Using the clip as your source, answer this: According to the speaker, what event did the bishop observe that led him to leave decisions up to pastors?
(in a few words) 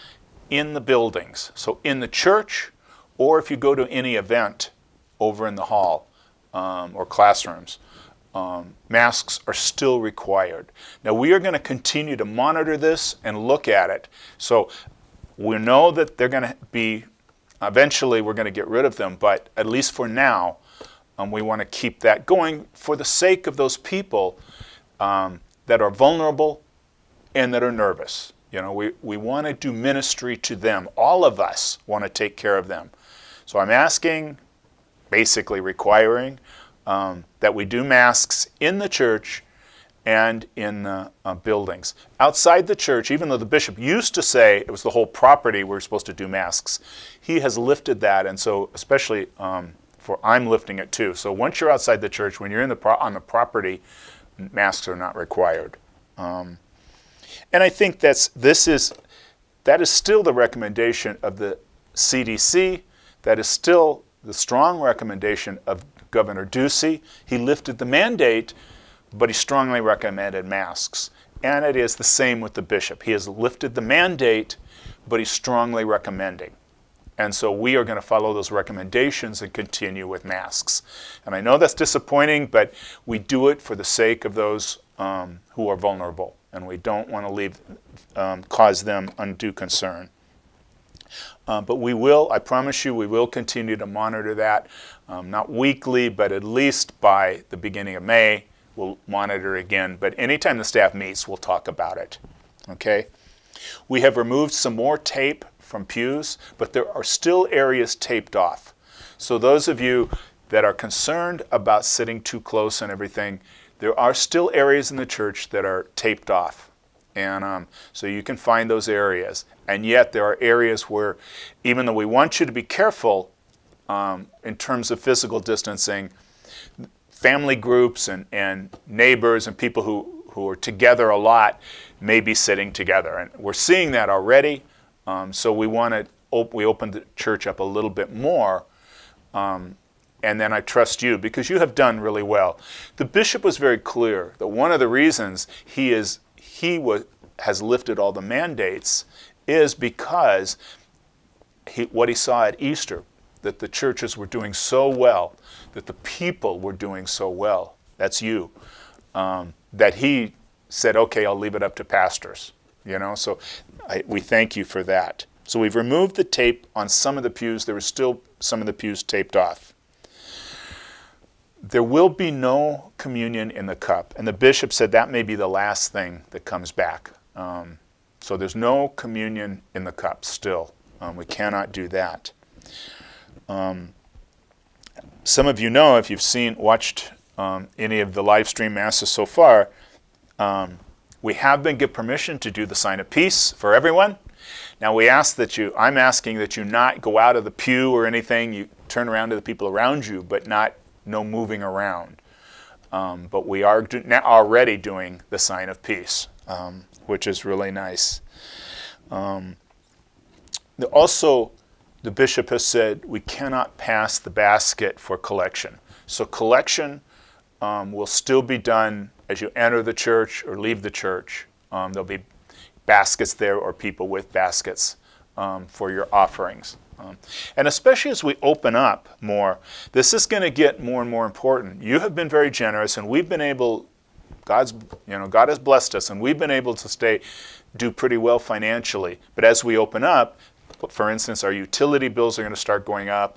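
Easter.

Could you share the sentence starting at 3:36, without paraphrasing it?
So collection um, will still be done as you enter the church or leave the church.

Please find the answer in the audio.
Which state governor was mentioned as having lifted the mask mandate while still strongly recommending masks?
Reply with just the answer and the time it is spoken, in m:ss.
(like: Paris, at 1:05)
Governor Ducey, at 1:06.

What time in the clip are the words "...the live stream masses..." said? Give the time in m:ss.
3:08.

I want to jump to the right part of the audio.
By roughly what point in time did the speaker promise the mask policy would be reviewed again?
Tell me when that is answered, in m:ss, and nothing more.
1:37.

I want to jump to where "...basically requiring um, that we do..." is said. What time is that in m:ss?
0:35.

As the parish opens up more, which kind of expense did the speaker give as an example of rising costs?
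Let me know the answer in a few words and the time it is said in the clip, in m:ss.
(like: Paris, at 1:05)
Utility bills, at 4:01.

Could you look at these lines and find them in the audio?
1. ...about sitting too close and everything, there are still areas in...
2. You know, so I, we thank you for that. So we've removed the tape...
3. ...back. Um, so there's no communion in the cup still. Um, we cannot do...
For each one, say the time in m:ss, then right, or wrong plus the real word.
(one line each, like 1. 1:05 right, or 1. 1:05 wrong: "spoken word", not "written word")
1. 1:51 right
2. 2:42 right
3. 2:56 right.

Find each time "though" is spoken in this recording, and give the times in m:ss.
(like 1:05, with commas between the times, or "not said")
0:43, 2:01.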